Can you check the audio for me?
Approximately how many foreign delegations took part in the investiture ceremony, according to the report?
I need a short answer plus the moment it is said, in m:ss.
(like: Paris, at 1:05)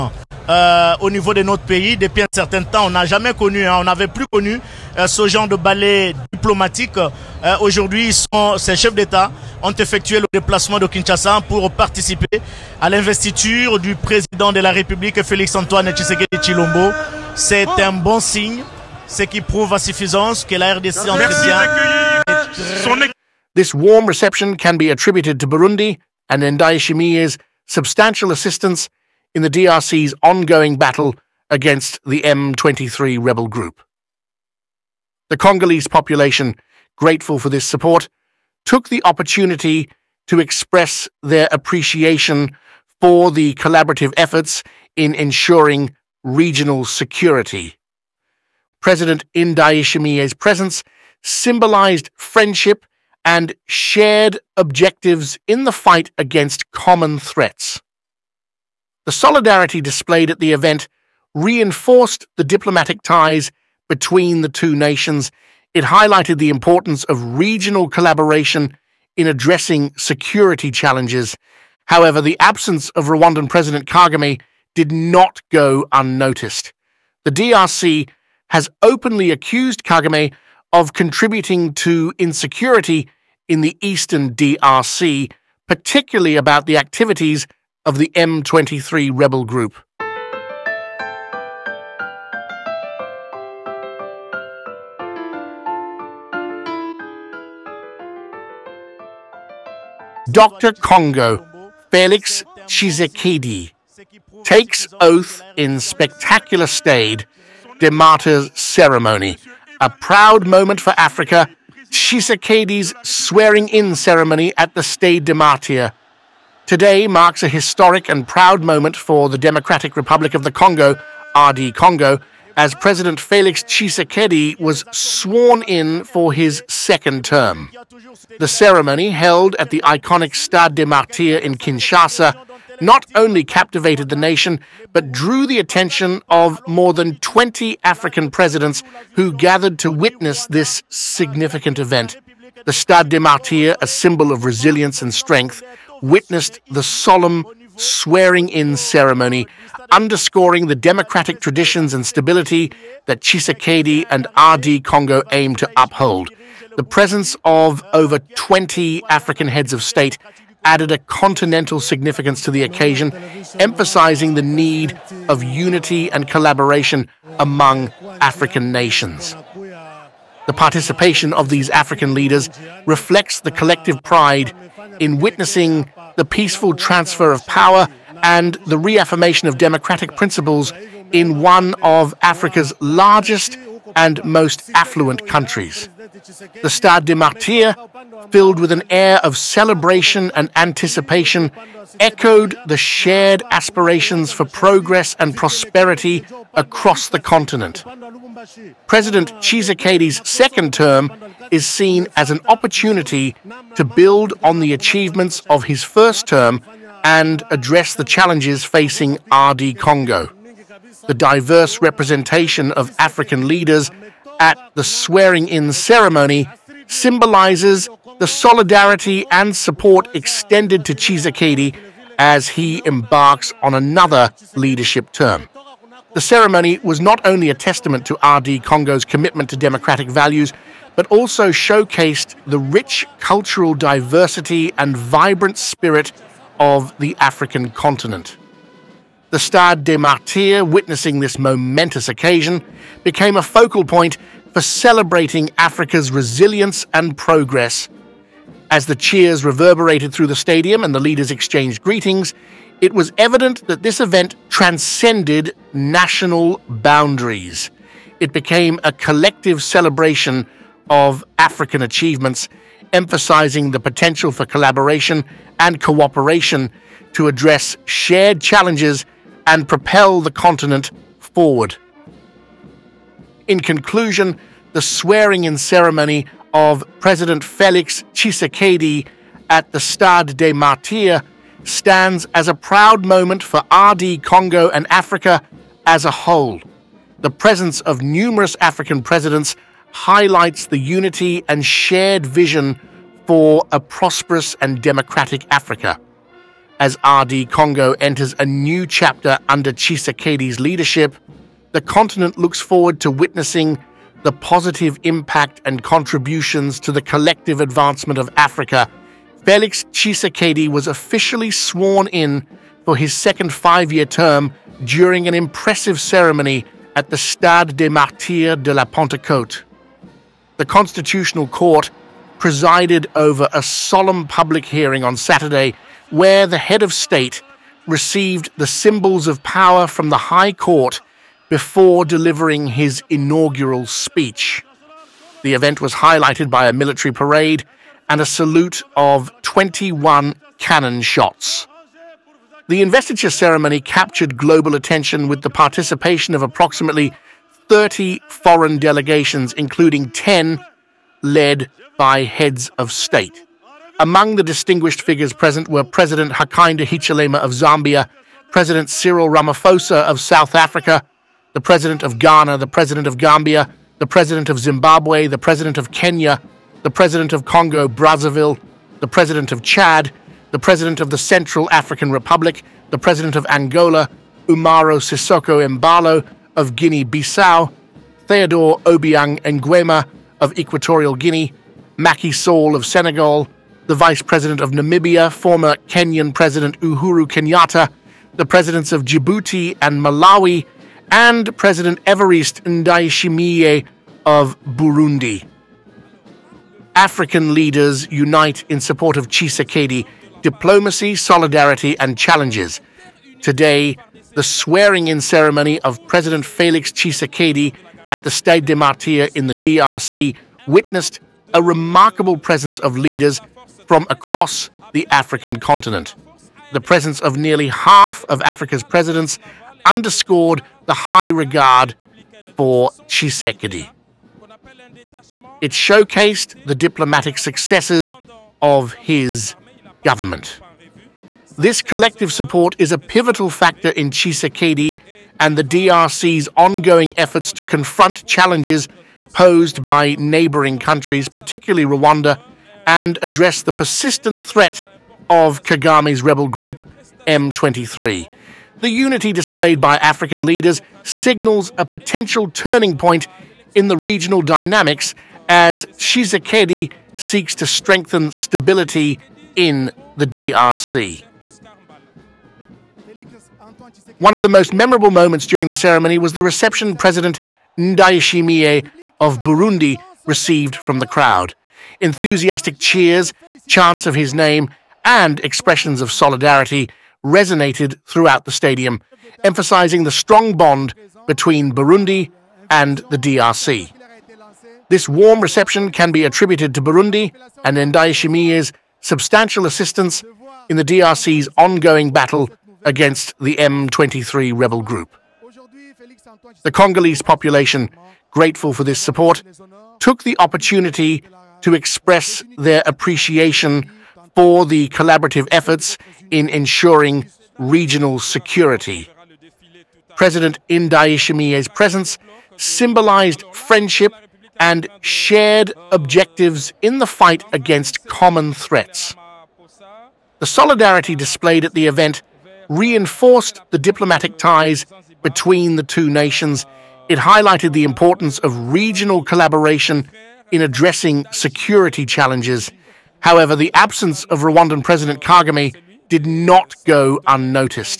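30, at 5:46.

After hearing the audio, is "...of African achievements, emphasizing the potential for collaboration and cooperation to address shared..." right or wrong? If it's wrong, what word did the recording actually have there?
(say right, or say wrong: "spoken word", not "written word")
right.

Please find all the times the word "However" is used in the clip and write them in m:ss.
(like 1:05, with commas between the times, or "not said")
1:11, 8:53.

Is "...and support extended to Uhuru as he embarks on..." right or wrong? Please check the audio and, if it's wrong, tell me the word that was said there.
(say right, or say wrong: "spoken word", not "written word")
wrong: "Tshisekedi", not "Uhuru".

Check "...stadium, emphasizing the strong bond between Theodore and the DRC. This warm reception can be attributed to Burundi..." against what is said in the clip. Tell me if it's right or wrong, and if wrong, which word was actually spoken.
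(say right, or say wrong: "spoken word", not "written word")
wrong: "Burundi", not "Theodore".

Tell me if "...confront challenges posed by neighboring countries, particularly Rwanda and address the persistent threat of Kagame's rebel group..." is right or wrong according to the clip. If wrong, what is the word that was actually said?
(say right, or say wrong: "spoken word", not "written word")
right.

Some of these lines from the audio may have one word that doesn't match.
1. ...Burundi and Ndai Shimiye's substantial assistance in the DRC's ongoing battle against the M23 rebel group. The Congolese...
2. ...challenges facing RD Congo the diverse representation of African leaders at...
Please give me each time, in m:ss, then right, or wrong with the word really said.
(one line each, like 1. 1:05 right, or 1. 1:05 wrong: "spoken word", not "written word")
1. 0:25 right
2. 3:28 right.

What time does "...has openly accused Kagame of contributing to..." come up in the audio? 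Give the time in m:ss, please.
1:18.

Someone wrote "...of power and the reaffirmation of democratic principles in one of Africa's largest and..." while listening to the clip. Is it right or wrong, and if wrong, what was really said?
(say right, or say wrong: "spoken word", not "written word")
right.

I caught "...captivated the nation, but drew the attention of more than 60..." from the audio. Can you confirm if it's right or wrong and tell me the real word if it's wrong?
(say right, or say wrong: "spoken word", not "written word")
wrong: "20", not "60".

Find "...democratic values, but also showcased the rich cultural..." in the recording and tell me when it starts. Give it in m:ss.
3:49.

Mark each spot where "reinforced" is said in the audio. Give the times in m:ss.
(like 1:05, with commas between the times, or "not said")
1:01, 8:42.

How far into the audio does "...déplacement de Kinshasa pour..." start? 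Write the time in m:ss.
0:10.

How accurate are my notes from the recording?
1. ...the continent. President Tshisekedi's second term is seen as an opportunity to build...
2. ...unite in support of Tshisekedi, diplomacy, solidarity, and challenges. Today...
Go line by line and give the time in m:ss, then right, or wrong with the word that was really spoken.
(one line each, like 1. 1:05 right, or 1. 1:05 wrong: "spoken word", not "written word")
1. 3:17 right
2. 6:38 right.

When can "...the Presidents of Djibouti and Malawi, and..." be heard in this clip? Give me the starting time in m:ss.
6:28.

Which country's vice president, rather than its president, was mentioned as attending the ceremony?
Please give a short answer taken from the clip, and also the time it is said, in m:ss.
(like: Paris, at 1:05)
Namibia, at 6:23.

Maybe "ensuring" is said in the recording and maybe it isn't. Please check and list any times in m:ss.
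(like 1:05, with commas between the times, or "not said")
0:45, 8:26.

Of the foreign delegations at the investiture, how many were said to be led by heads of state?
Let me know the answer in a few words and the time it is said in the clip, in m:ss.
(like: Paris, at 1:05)
10, at 5:50.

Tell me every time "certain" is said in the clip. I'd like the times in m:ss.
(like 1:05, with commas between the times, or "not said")
0:02.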